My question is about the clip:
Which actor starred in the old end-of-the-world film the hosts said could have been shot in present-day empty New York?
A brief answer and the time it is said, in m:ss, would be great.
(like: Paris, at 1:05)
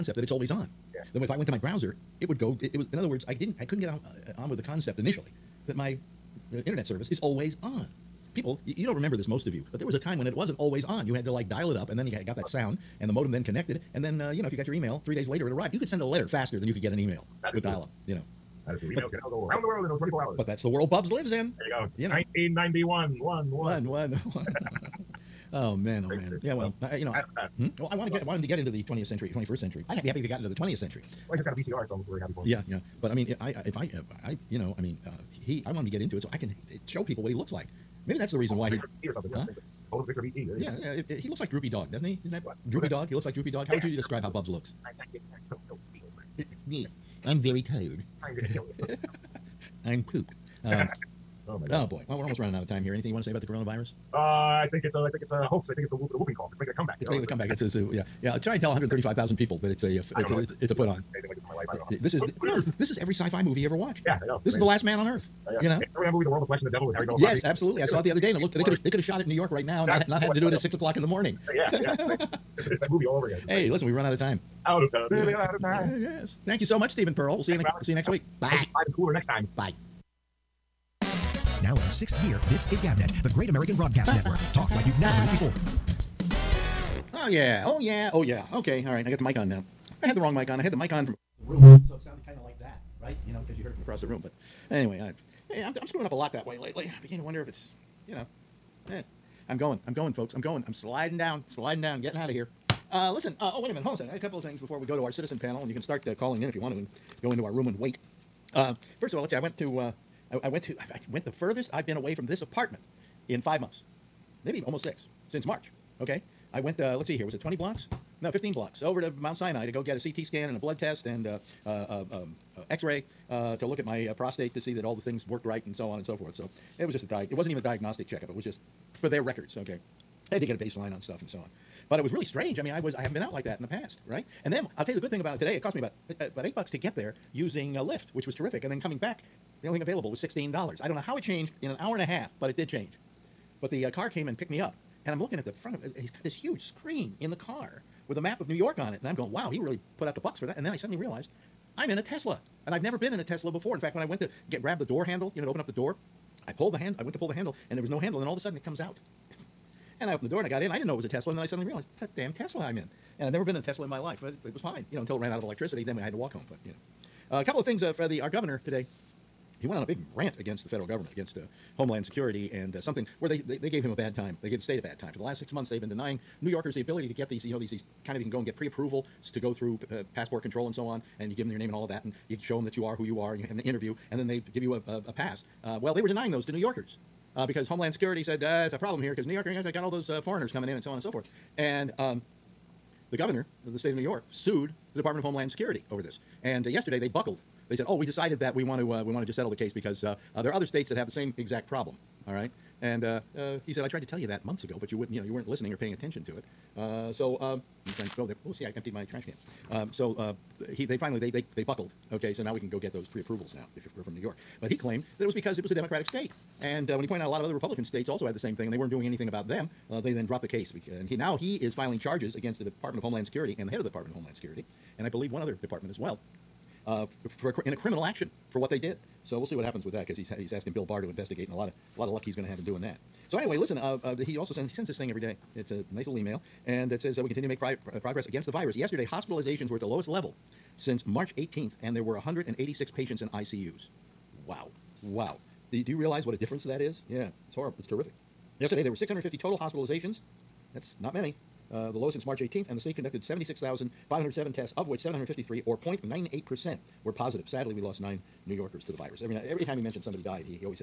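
Harry Belafonte, at 1:06.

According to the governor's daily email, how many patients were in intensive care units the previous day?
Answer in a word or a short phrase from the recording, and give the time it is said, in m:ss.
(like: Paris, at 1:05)
186, at 4:02.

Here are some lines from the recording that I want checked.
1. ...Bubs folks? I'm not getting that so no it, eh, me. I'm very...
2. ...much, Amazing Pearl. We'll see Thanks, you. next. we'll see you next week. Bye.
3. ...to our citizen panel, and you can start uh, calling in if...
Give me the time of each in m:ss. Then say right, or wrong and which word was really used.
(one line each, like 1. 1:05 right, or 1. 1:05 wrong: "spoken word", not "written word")
1. 0:44 wrong: "looks", not "folks"
2. 1:16 wrong: "Stephen", not "Amazing"
3. 1:44 right.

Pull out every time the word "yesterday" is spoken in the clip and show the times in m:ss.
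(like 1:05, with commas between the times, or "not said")
3:16, 3:58, 4:08.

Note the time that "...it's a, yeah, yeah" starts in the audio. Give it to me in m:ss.
0:57.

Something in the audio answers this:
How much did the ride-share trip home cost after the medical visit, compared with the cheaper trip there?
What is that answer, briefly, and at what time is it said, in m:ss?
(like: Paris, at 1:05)
$16, at 2:20.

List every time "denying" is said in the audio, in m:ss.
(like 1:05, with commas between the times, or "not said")
2:55, 3:06.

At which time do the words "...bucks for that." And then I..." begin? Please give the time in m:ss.
2:30.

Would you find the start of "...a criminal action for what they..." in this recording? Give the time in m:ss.
3:47.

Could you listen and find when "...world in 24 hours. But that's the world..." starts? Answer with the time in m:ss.
0:19.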